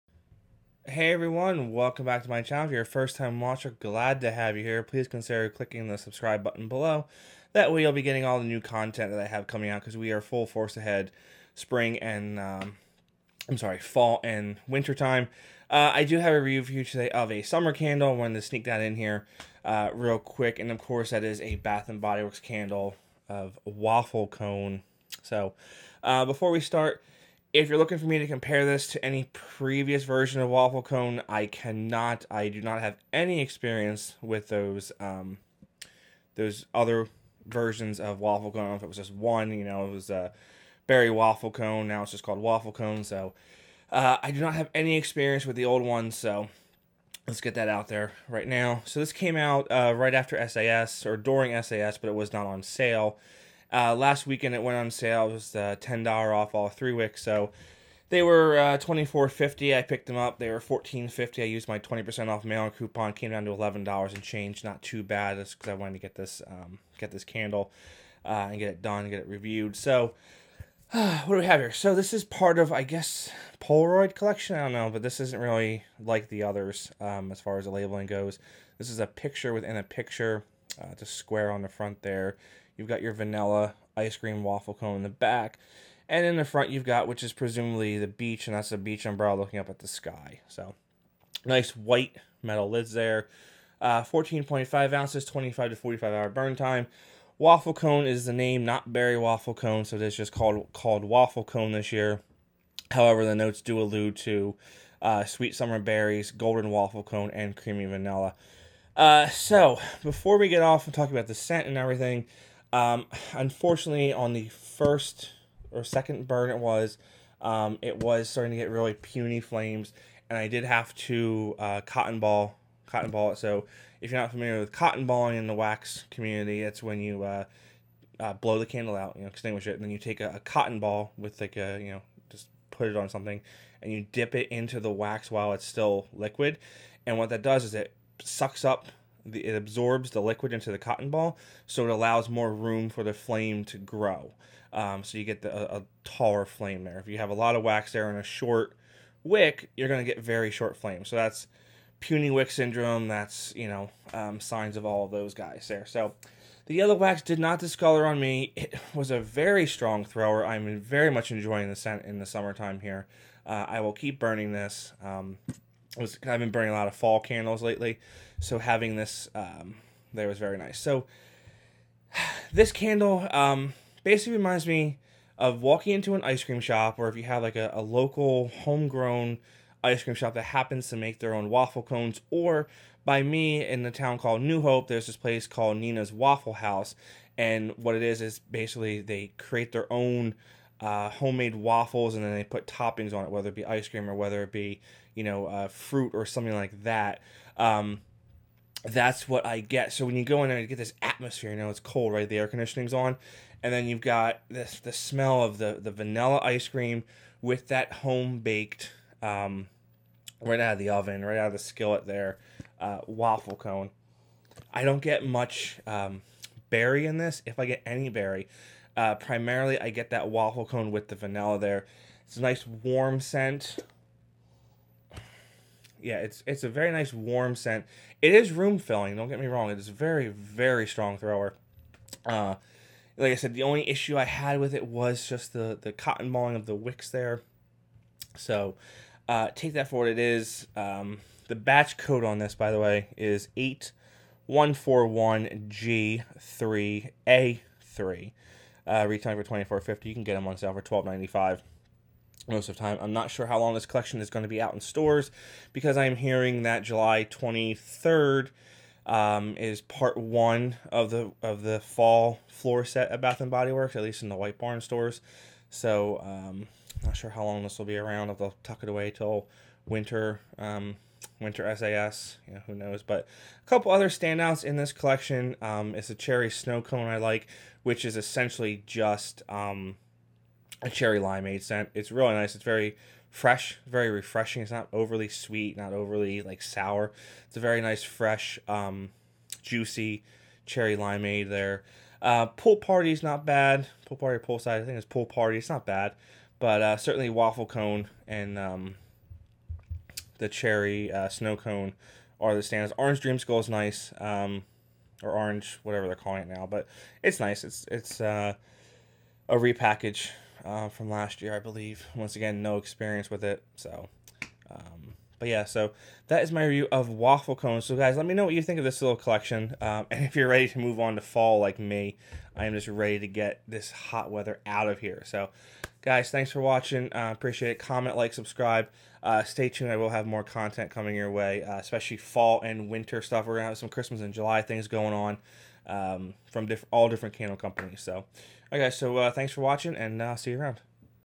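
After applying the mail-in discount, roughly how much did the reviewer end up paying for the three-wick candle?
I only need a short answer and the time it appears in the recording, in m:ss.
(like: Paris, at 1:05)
$11, at 1:03.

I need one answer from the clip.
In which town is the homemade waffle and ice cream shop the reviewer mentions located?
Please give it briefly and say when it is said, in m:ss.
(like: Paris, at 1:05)
New Hope, at 3:04.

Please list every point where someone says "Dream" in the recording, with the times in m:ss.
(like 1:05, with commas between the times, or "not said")
5:03.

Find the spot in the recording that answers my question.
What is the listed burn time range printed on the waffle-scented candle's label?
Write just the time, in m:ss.
1:35.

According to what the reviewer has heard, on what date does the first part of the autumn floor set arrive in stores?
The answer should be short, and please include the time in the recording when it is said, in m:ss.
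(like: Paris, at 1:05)
July 23rd, at 4:16.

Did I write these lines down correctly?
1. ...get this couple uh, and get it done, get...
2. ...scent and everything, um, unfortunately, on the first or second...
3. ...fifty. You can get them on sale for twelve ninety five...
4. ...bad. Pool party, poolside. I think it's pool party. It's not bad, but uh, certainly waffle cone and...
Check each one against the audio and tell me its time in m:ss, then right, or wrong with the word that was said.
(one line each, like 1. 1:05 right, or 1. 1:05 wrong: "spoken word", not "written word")
1. 1:06 wrong: "candle", not "couple"
2. 1:51 right
3. 4:09 right
4. 4:53 right.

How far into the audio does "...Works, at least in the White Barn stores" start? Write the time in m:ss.
4:23.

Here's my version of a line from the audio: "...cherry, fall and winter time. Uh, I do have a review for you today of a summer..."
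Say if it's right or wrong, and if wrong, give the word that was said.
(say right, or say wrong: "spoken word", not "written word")
wrong: "sorry", not "cherry".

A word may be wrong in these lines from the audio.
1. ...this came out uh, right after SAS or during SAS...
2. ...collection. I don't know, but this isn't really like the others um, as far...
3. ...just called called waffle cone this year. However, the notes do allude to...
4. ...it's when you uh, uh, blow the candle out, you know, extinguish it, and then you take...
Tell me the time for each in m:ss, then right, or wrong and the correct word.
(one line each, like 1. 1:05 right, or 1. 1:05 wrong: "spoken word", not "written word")
1. 0:49 right
2. 1:14 right
3. 1:40 right
4. 2:06 right.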